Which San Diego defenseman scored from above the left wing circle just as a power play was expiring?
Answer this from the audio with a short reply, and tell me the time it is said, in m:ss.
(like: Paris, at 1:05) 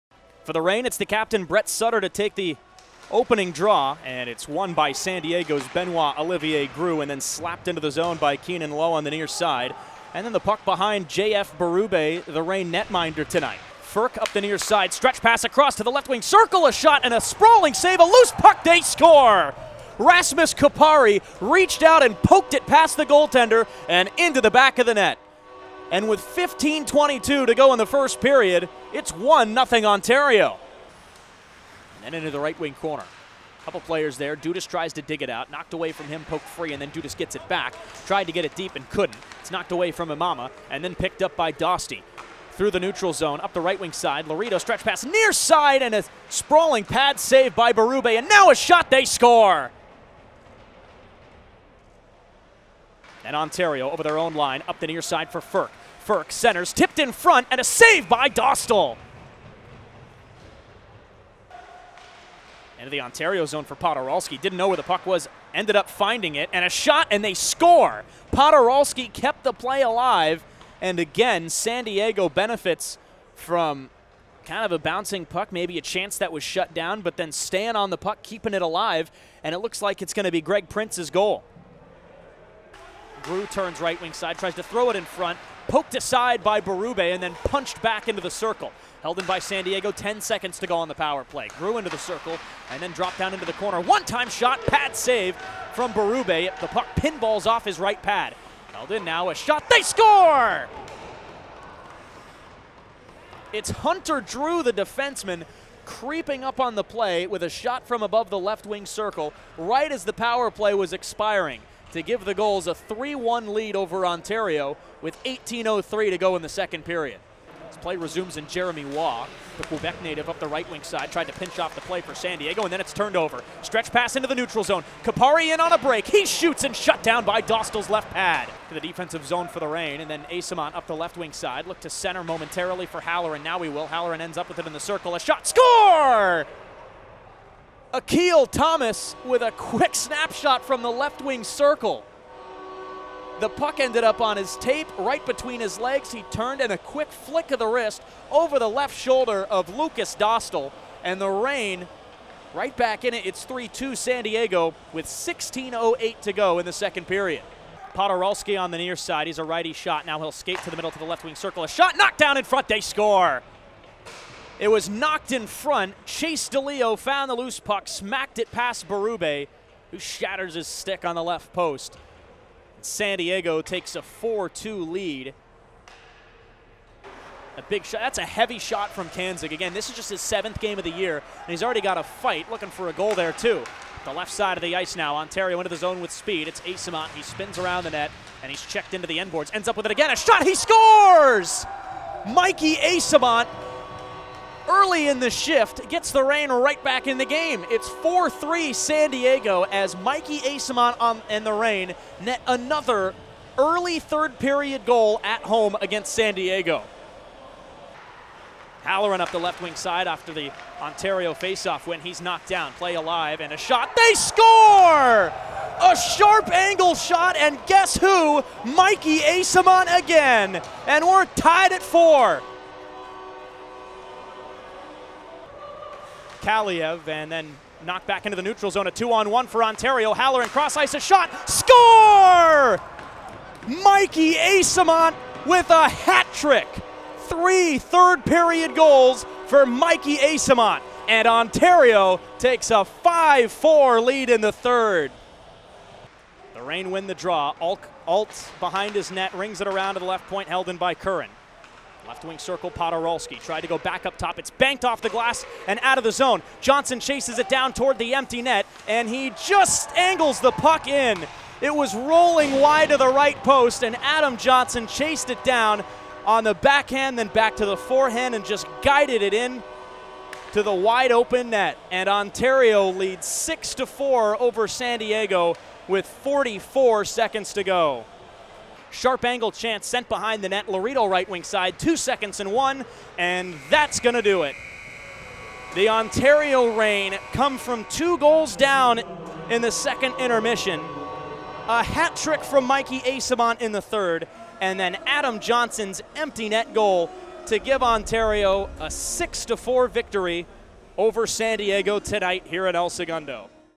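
Hunter Drew, at 1:43.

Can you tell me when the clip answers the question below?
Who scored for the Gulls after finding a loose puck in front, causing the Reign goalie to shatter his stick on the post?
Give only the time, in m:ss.
2:46.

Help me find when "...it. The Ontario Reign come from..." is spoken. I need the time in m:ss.
4:44.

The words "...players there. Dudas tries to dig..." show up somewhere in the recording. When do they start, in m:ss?
0:33.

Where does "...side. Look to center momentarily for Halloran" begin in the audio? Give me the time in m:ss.
2:11.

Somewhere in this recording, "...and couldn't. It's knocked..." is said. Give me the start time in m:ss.
0:38.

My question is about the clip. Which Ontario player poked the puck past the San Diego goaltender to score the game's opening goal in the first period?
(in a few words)
Rasmus Kupari.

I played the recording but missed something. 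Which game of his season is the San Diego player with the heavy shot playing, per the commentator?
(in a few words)
7th.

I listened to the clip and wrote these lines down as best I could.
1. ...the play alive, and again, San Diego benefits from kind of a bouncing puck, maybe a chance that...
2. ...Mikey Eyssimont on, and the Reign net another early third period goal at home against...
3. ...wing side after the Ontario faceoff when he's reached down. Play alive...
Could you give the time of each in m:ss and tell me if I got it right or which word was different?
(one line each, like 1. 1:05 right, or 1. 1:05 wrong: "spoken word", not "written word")
1. 1:09 right
2. 3:19 right
3. 3:29 wrong: "knocked", not "reached".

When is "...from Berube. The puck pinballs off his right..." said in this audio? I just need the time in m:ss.
1:35.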